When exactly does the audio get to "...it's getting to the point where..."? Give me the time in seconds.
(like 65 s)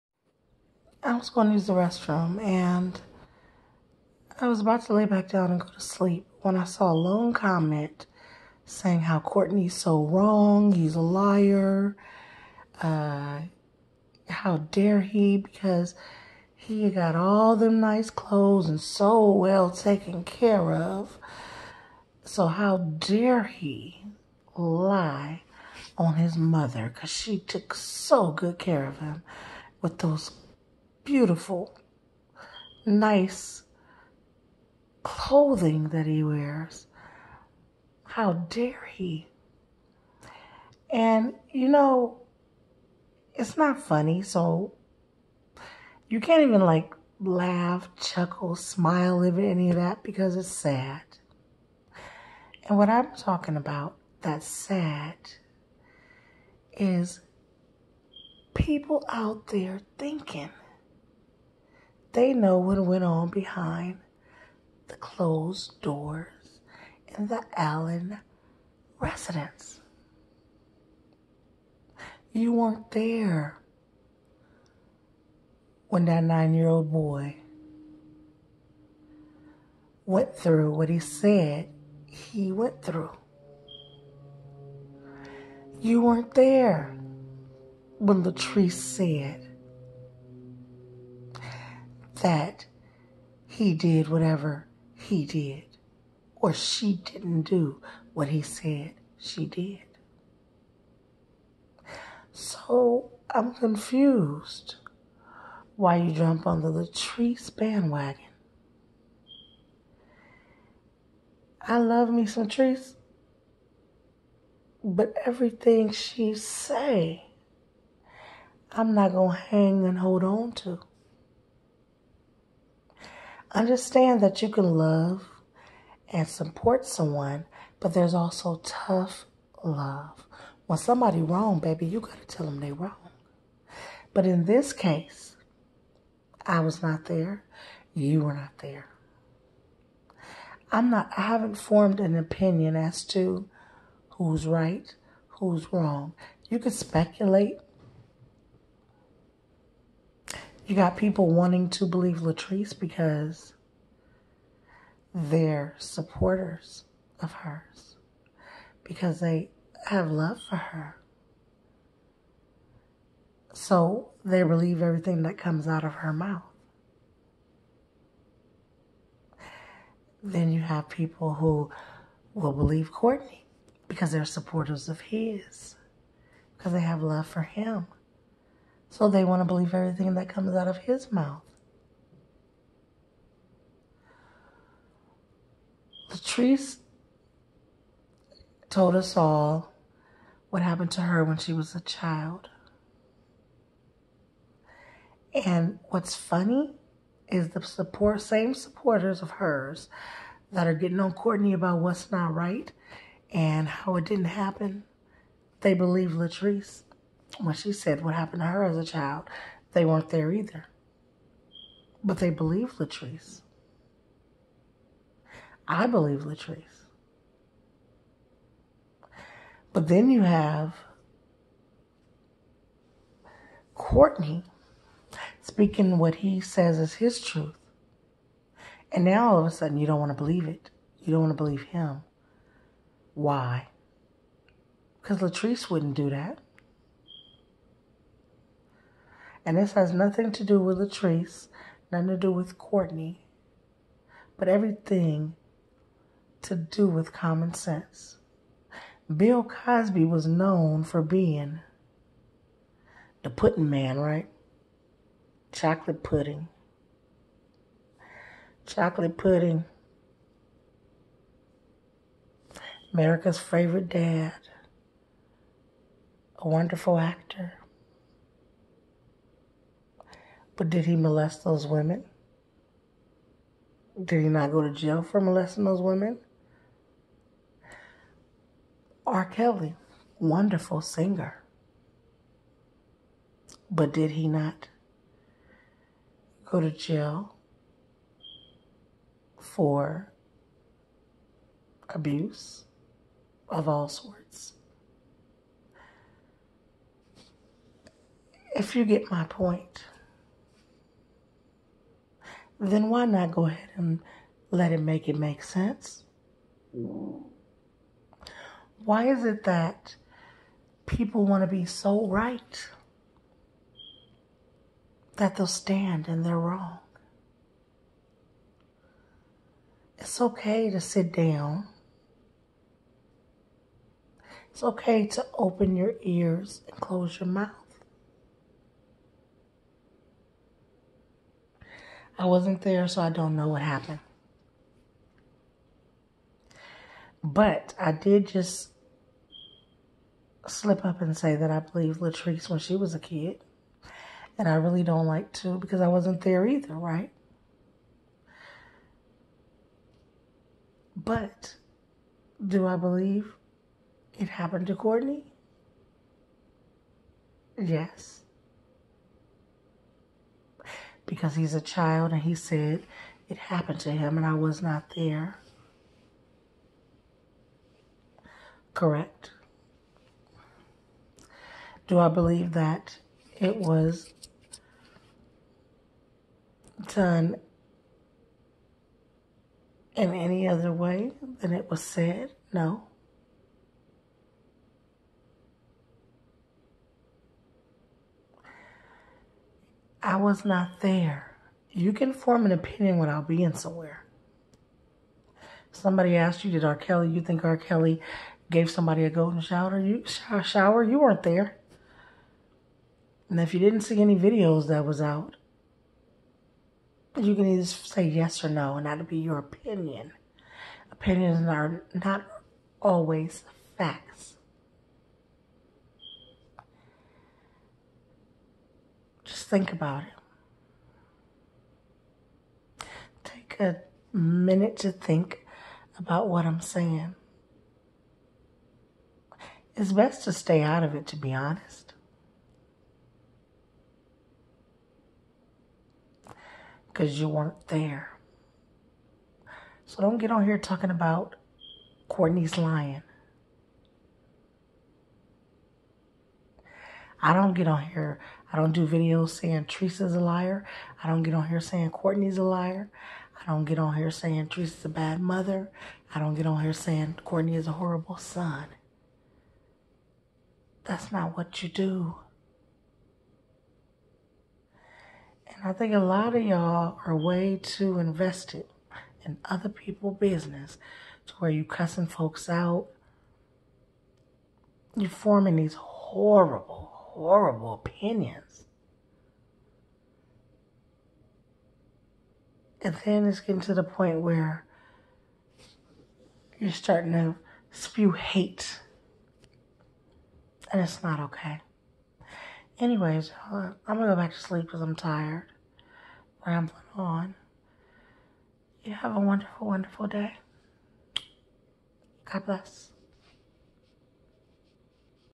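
483 s.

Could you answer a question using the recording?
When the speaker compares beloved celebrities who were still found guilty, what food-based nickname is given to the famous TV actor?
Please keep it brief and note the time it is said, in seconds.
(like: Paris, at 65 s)
the pudding man, at 253 s.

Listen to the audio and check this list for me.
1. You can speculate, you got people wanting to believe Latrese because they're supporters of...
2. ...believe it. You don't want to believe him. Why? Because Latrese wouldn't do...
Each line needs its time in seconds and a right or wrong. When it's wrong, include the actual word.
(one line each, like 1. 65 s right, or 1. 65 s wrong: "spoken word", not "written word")
1. 146 s right
2. 230 s right.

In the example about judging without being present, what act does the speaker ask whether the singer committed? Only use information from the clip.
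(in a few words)
golden shower.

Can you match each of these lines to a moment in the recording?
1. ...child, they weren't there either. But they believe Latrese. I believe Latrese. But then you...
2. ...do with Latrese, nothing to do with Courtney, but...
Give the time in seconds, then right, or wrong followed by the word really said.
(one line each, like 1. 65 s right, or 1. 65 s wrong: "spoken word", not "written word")
1. 208 s right
2. 240 s right.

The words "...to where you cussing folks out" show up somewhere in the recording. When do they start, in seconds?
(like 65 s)
471 s.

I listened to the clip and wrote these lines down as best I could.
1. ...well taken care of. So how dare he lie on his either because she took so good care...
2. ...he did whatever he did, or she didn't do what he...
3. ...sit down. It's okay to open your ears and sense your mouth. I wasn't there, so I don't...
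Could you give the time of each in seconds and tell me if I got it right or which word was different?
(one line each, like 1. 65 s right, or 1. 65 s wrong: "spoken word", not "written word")
1. 19 s wrong: "mother", not "either"
2. 93 s right
3. 320 s wrong: "close", not "sense".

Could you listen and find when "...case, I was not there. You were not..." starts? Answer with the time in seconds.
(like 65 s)
134 s.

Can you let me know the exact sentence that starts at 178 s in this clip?
So they want to believe everything that comes out of his mouth.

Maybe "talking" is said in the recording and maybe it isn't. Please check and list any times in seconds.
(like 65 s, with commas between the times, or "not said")
53 s, 440 s.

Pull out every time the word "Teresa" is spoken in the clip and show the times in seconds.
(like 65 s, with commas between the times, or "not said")
449 s, 454 s.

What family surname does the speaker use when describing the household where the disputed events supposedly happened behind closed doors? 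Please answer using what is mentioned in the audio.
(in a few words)
Allen.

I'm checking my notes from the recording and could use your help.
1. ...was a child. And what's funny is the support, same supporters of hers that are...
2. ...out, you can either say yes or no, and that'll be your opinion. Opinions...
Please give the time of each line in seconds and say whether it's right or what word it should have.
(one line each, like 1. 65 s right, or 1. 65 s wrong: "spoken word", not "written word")
1. 191 s right
2. 405 s right.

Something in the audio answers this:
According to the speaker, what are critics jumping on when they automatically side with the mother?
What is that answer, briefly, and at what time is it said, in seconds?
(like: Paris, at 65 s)
the Latrese bandwagon, at 106 s.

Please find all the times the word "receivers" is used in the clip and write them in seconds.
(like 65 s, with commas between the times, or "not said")
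not said.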